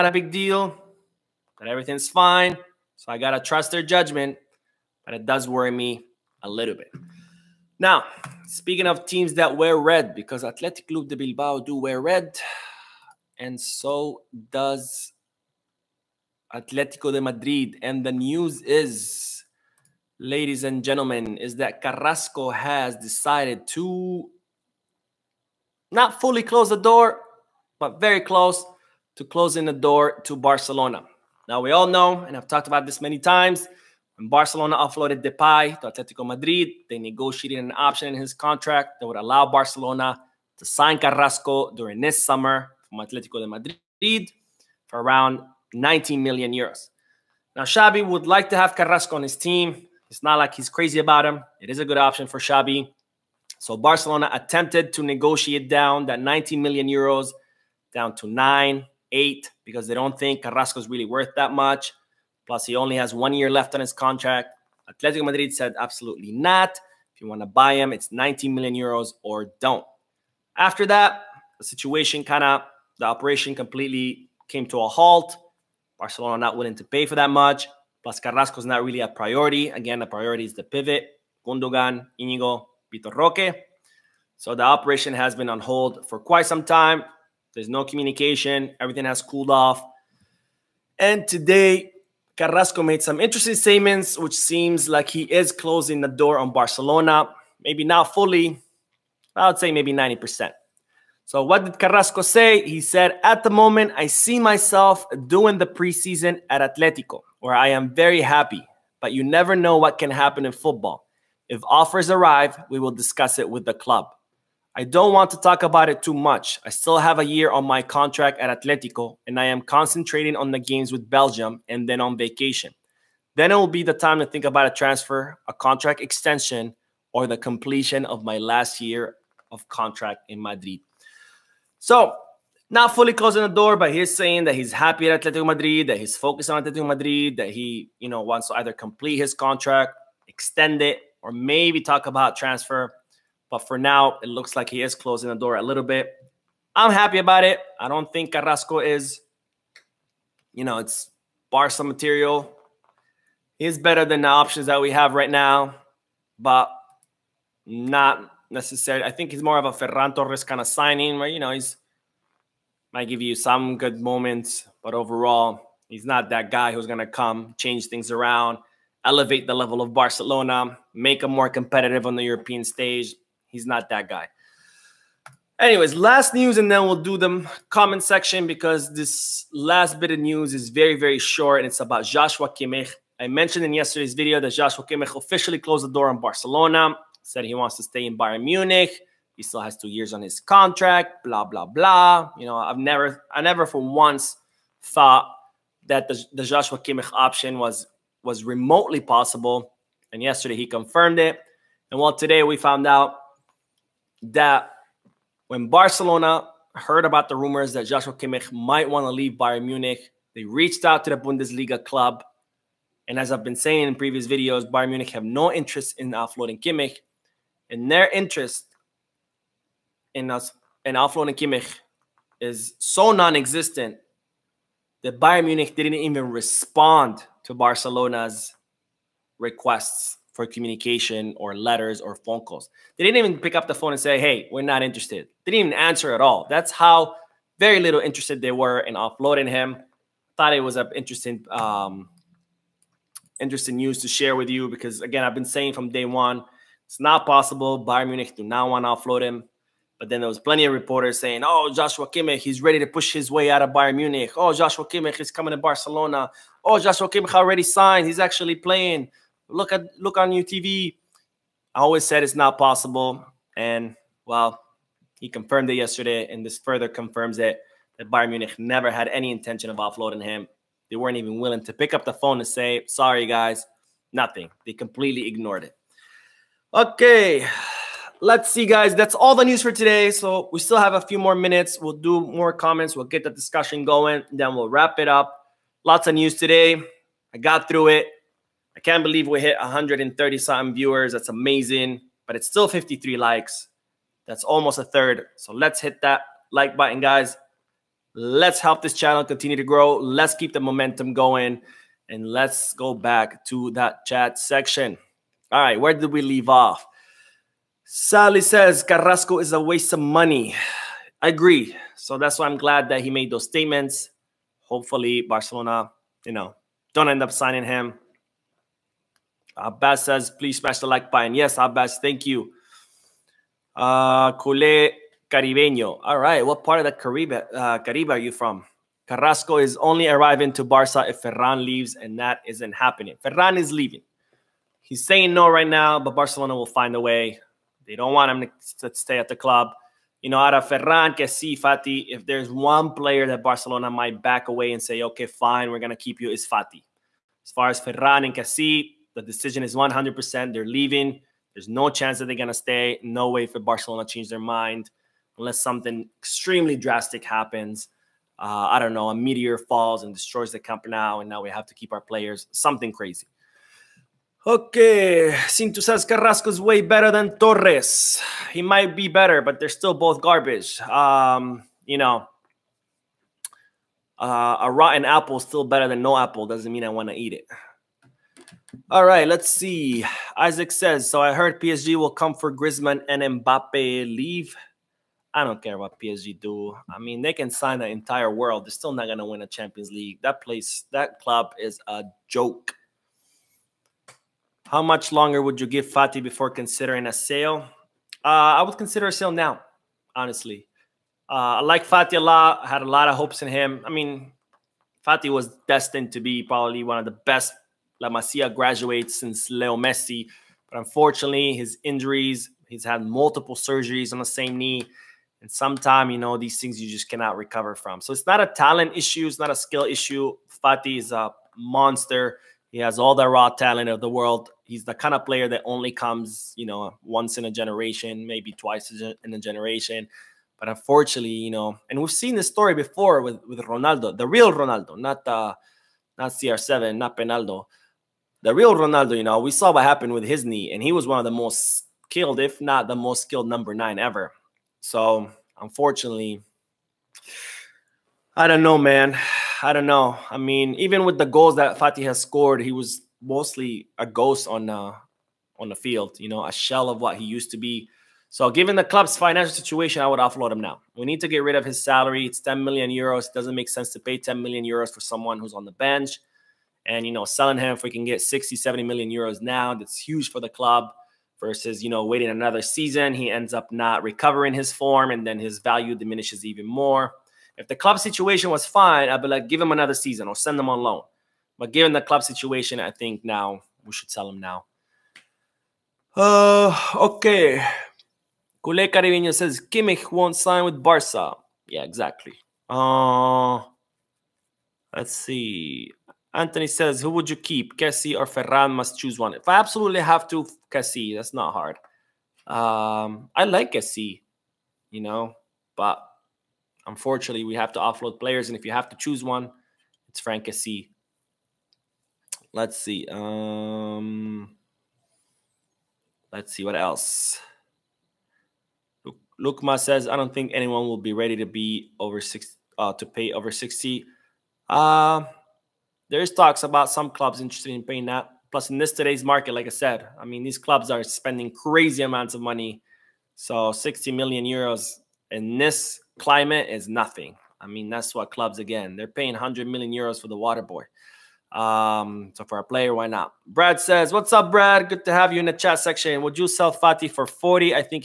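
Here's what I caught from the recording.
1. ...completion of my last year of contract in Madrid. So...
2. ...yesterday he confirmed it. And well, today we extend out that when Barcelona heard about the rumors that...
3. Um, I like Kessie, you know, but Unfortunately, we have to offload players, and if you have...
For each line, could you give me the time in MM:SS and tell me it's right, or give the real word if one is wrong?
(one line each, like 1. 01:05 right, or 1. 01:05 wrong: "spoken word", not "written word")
1. 02:07 right
2. 03:20 wrong: "found", not "extend"
3. 08:22 right.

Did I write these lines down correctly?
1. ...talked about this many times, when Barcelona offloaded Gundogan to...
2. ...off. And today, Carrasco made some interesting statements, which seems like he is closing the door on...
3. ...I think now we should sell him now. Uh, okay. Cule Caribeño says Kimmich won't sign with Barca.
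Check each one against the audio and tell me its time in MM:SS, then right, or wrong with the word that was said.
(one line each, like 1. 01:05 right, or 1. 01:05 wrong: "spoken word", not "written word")
1. 00:32 wrong: "Depay", not "Gundogan"
2. 01:29 right
3. 08:02 right.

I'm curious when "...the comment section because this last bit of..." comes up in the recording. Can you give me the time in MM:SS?
02:57.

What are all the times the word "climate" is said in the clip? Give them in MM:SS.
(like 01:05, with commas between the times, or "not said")
08:56.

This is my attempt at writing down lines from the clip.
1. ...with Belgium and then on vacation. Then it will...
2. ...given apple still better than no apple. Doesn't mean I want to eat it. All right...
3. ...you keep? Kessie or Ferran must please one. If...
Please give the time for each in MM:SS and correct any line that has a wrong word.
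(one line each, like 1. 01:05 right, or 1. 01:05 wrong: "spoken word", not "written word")
1. 02:00 right
2. 06:14 wrong: "rotten", not "given"
3. 08:17 wrong: "choose", not "please".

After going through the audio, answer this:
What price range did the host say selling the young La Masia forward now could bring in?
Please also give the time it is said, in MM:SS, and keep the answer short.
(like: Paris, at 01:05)
60-70 million euros, at 07:48.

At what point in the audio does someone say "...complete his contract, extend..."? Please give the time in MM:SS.
02:18.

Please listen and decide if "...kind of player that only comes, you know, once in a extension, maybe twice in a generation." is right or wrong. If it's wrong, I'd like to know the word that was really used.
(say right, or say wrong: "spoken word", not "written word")
wrong: "generation", not "extension".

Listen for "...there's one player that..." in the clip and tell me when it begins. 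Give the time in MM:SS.
05:42.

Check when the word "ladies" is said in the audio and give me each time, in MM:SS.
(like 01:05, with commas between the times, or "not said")
00:20.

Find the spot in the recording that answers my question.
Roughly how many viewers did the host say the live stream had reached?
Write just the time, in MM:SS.
04:49.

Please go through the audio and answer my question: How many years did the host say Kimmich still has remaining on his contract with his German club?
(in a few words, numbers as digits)
2.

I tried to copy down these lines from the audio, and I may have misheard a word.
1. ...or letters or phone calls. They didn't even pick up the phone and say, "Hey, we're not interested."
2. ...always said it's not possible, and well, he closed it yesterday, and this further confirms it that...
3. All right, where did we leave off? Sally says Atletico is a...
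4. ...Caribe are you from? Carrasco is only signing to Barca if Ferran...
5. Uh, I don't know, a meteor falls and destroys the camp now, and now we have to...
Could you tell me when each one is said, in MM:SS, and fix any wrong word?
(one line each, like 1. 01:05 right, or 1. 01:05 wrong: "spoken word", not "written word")
1. 03:51 right
2. 04:21 wrong: "confirmed", not "closed"
3. 05:05 wrong: "Carrasco", not "Atletico"
4. 05:27 wrong: "arriving", not "signing"
5. 05:58 right.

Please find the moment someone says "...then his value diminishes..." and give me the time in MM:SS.
07:55.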